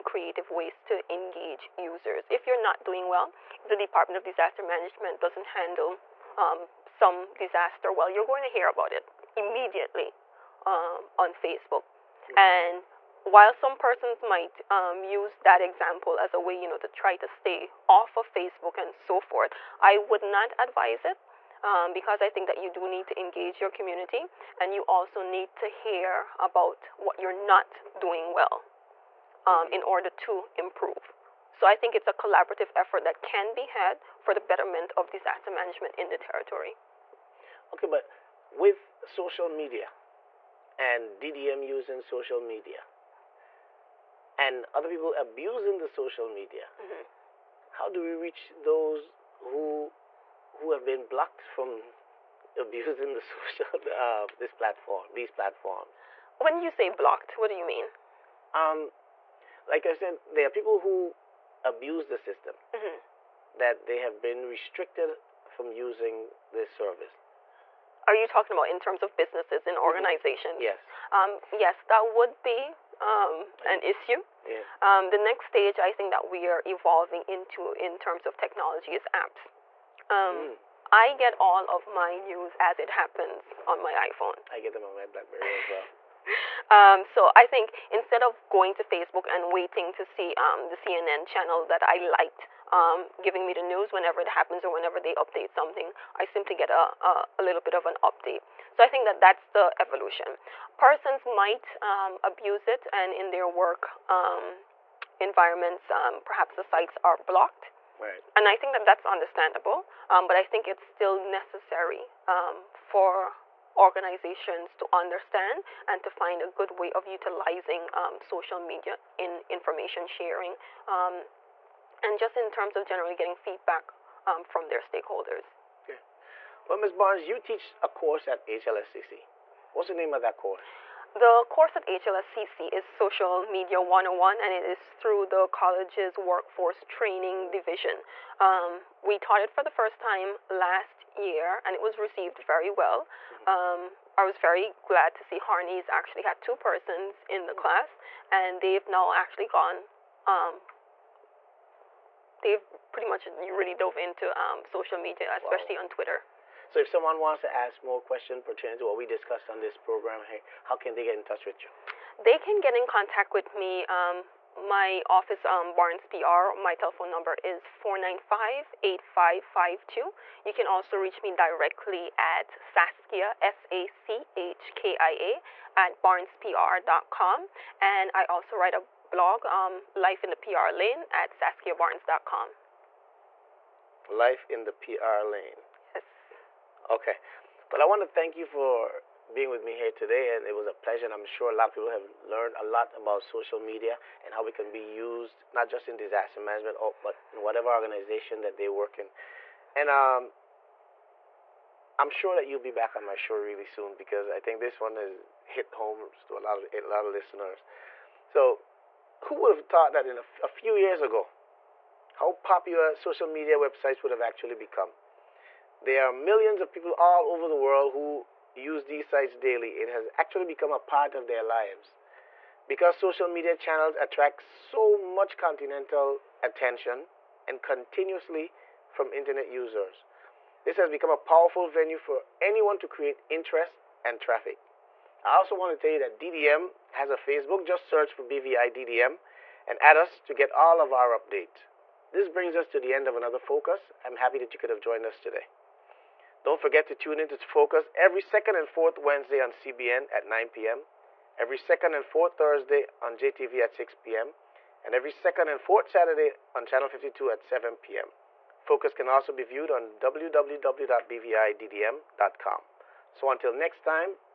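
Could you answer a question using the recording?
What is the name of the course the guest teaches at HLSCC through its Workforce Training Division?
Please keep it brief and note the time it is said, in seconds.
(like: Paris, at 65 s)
Social Media 101, at 132 s.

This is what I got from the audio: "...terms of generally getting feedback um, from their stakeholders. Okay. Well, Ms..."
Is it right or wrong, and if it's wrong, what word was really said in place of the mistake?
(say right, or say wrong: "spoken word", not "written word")
right.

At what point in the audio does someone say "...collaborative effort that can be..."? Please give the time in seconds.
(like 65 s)
32 s.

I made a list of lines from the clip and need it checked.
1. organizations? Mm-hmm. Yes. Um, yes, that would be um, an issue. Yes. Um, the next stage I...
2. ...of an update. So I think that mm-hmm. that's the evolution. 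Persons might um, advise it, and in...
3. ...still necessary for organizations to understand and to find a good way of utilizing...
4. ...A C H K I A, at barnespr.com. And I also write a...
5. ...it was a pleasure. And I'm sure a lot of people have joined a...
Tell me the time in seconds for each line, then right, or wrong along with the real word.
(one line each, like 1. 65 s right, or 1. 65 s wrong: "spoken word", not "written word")
1. 69 s right
2. 97 s wrong: "abuse", not "advise"
3. 110 s right
4. 173 s right
5. 190 s wrong: "learned", not "joined".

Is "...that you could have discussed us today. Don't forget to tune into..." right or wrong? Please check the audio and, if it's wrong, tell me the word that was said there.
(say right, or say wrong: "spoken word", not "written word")
wrong: "joined", not "discussed".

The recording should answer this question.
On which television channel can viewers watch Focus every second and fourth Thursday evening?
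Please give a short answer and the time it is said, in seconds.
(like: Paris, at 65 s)
JTV, at 253 s.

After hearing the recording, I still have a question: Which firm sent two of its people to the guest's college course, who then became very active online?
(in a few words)
Harney's.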